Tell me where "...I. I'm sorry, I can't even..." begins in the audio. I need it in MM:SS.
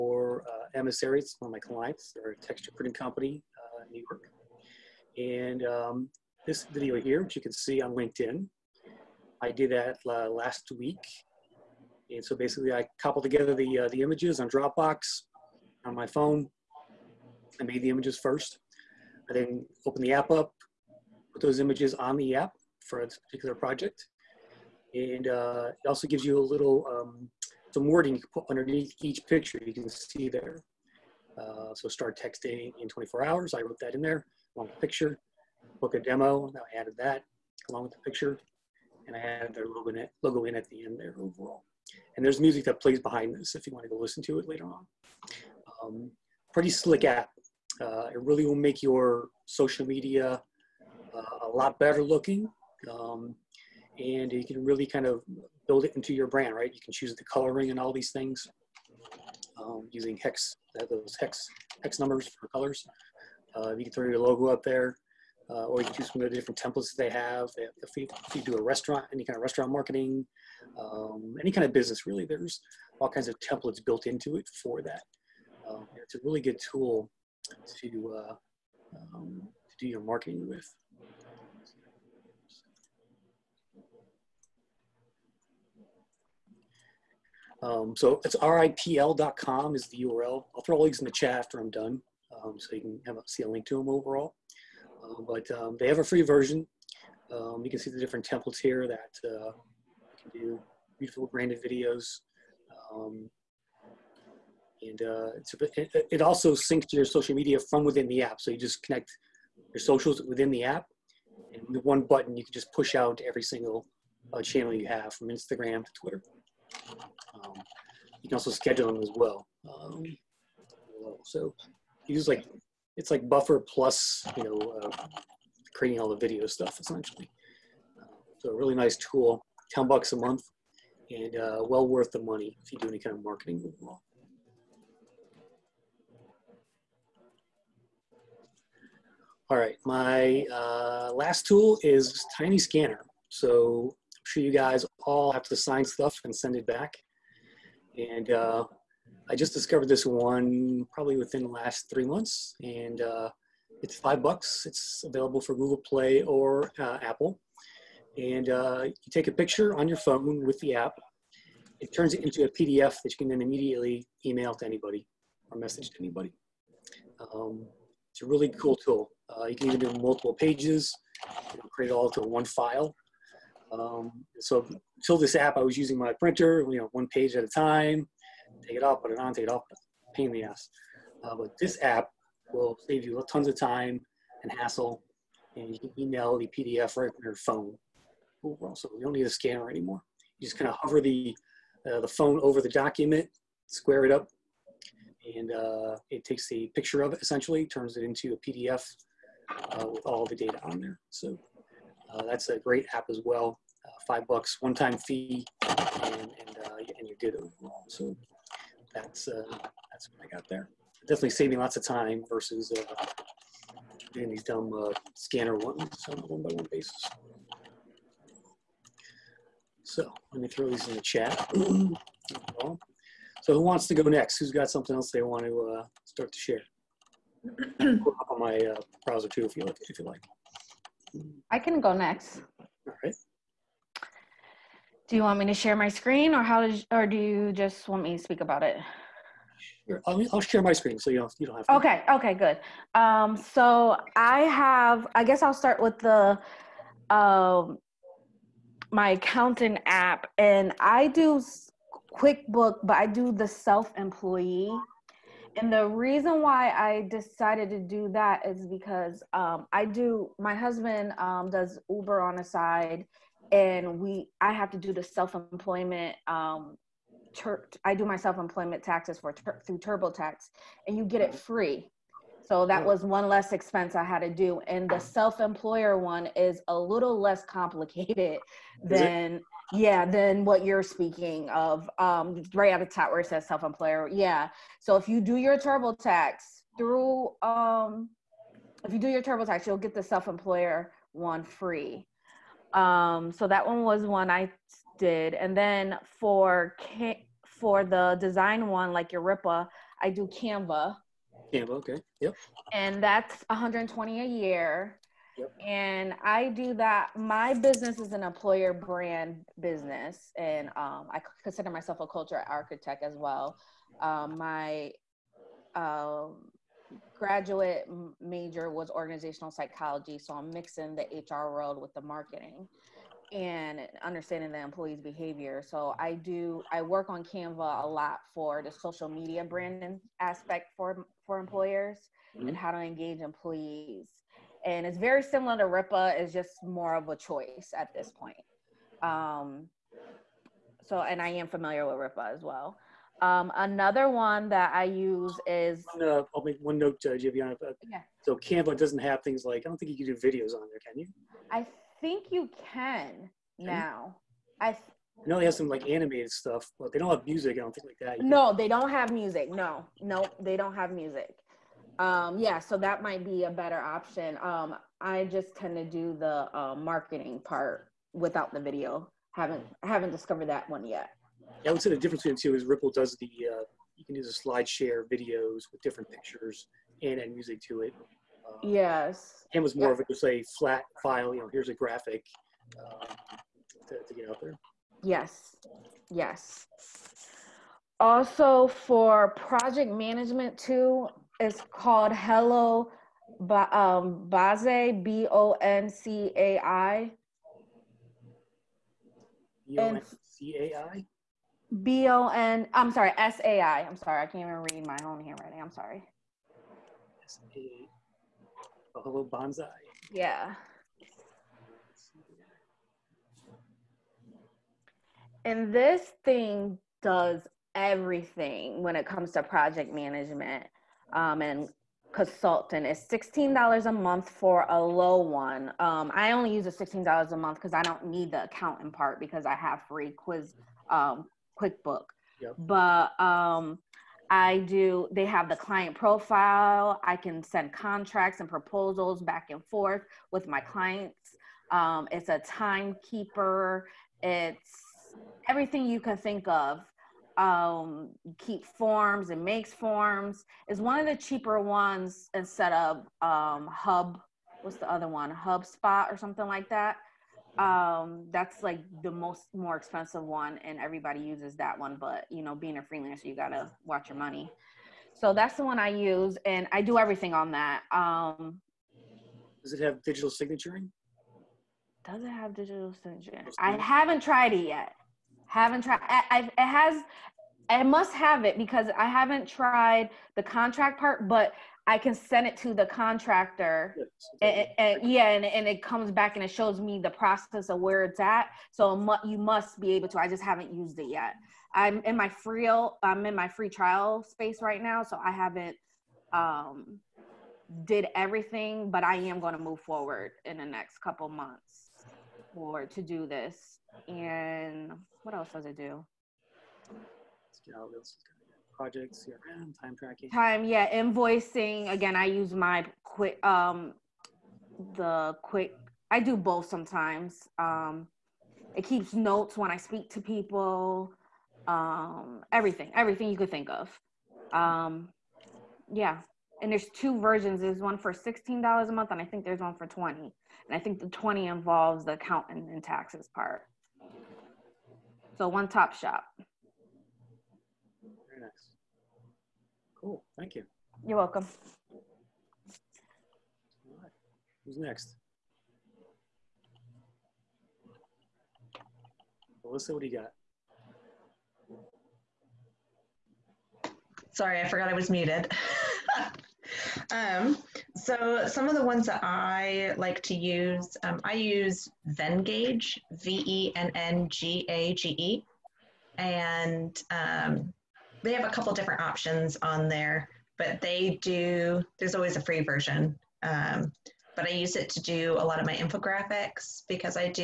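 06:43.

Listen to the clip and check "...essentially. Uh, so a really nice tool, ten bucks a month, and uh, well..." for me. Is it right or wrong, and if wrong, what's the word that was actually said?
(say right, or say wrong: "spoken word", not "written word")
right.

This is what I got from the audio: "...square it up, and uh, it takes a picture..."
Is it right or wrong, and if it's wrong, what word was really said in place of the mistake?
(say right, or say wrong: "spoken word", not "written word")
right.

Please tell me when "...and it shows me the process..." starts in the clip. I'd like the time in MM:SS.
08:06.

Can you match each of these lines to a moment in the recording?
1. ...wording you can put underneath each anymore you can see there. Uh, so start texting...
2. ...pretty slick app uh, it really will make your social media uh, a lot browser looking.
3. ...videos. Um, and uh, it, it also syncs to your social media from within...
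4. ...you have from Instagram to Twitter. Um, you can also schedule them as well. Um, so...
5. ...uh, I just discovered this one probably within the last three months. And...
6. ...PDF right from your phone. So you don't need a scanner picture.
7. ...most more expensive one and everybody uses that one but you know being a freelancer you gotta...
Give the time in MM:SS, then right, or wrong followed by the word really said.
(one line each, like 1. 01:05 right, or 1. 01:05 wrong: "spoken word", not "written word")
1. 00:27 wrong: "picture", not "anymore"
2. 00:46 wrong: "better", not "browser"
3. 01:41 right
4. 01:54 right
5. 02:28 right
6. 03:06 wrong: "anymore", not "picture"
7. 07:39 right.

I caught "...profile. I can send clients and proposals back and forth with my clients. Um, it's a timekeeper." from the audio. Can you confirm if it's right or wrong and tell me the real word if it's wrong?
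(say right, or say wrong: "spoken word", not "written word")
wrong: "contracts", not "clients".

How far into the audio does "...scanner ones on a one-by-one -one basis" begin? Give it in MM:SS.
03:35.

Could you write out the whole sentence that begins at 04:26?
Um, tur- I do my self employment taxes for tur- through TurboTax, and you get it free.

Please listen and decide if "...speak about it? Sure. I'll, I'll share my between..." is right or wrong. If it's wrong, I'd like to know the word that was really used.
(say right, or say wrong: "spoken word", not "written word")
wrong: "screen", not "between".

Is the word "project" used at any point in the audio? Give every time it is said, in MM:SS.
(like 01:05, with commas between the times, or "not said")
00:23, 06:29, 06:59, 08:28.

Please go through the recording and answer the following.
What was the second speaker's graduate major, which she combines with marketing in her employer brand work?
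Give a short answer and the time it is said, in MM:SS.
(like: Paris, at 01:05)
Organizational psychology, at 05:18.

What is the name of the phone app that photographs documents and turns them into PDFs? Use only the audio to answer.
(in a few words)
Tiny Scanner.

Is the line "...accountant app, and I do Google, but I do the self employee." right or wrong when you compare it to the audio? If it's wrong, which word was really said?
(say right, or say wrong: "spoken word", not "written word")
wrong: "QuickBook", not "Google".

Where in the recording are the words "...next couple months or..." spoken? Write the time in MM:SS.
08:20.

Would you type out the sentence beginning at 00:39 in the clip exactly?
And I added their logo in, logo in at the end there overall.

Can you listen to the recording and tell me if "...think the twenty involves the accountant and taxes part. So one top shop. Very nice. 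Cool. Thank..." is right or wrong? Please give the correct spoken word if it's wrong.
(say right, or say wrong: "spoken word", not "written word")
right.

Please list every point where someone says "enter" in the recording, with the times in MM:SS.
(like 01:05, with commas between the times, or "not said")
not said.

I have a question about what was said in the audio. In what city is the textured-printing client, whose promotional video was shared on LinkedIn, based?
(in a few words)
New York.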